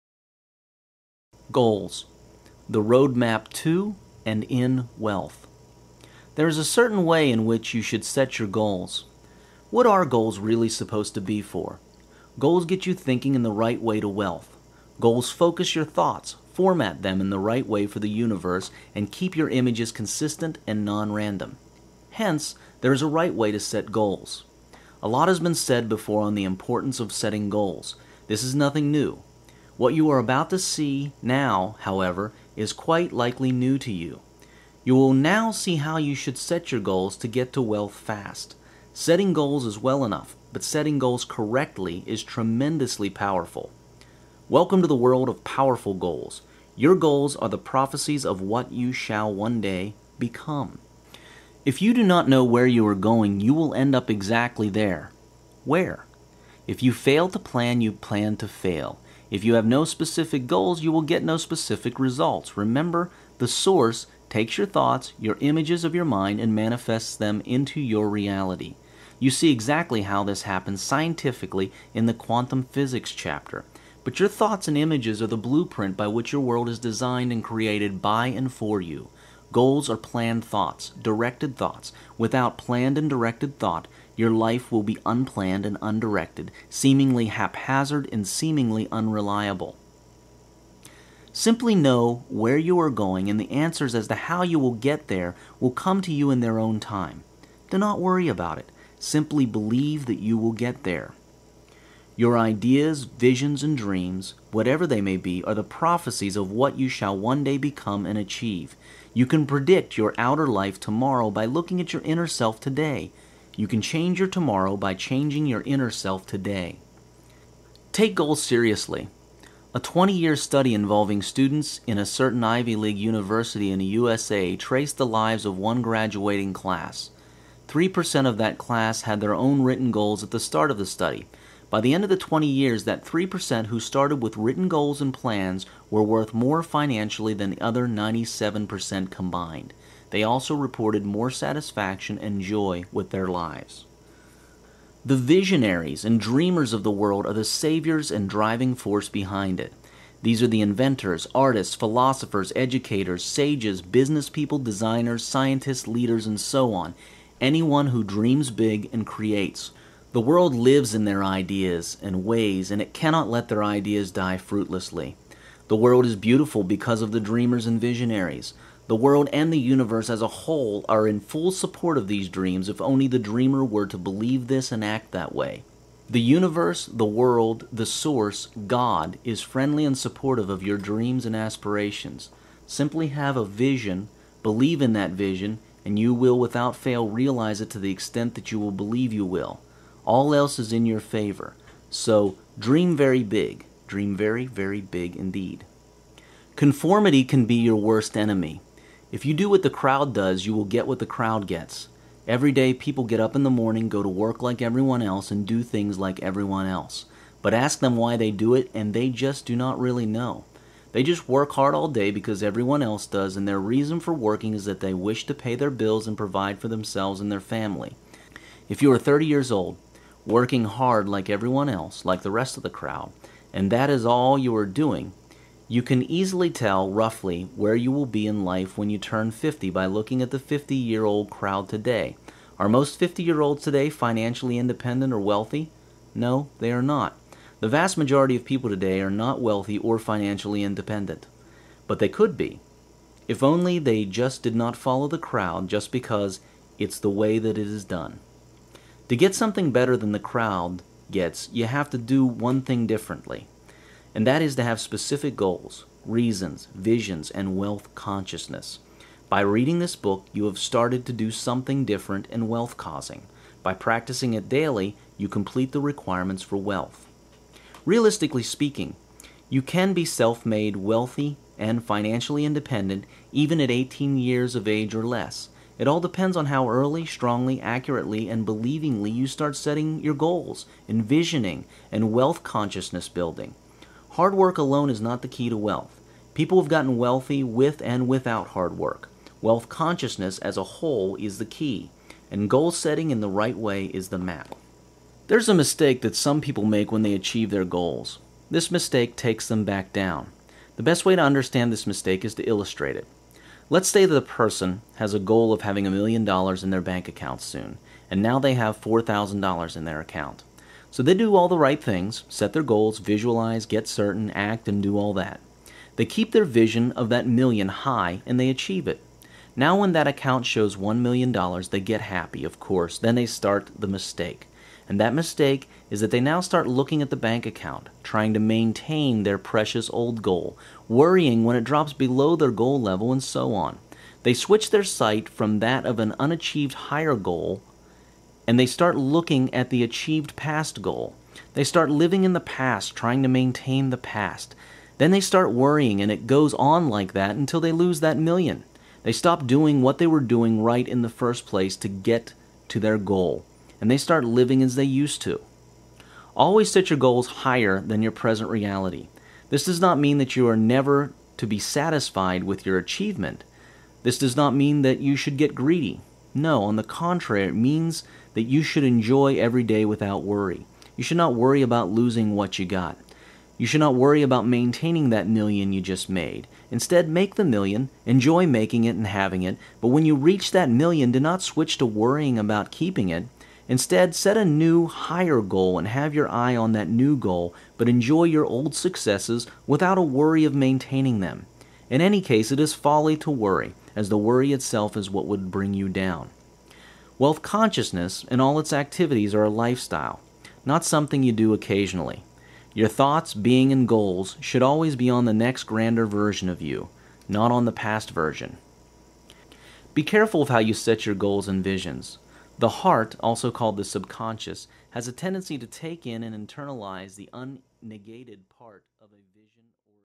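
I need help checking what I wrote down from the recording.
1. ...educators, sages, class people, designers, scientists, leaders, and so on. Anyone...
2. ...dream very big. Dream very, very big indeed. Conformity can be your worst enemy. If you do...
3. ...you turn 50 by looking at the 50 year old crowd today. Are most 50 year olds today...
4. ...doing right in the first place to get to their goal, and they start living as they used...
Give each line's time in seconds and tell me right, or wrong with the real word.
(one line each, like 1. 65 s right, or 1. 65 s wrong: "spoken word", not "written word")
1. 152 s wrong: "business", not "class"
2. 192 s right
3. 228 s right
4. 350 s right.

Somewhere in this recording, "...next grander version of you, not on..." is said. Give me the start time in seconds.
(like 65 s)
405 s.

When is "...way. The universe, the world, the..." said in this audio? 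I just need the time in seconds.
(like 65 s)
175 s.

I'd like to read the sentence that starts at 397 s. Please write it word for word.
Wealth consciousness and all its activities are a lifestyle, not something you do occasionally.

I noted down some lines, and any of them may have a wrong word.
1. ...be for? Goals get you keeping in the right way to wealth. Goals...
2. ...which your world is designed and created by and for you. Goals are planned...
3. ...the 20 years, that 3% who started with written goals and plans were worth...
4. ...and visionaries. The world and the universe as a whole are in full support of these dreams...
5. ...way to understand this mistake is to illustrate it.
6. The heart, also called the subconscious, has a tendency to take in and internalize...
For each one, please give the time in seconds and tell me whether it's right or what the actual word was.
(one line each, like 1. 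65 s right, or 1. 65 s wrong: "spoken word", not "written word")
1. 11 s wrong: "thinking", not "keeping"
2. 76 s right
3. 132 s right
4. 167 s right
5. 301 s right
6. 412 s right.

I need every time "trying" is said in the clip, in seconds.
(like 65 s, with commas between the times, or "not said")
328 s, 342 s.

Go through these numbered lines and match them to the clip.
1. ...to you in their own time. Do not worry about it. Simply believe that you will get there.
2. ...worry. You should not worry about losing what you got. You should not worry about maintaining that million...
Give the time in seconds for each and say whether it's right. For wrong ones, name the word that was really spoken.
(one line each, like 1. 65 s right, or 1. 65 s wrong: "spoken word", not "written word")
1. 96 s right
2. 370 s right.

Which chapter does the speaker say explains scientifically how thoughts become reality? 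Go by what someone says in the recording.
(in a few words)
quantum physics chapter.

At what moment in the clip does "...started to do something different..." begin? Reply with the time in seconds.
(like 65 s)
260 s.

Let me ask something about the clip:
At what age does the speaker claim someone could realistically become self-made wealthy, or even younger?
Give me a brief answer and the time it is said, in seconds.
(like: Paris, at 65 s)
18, at 273 s.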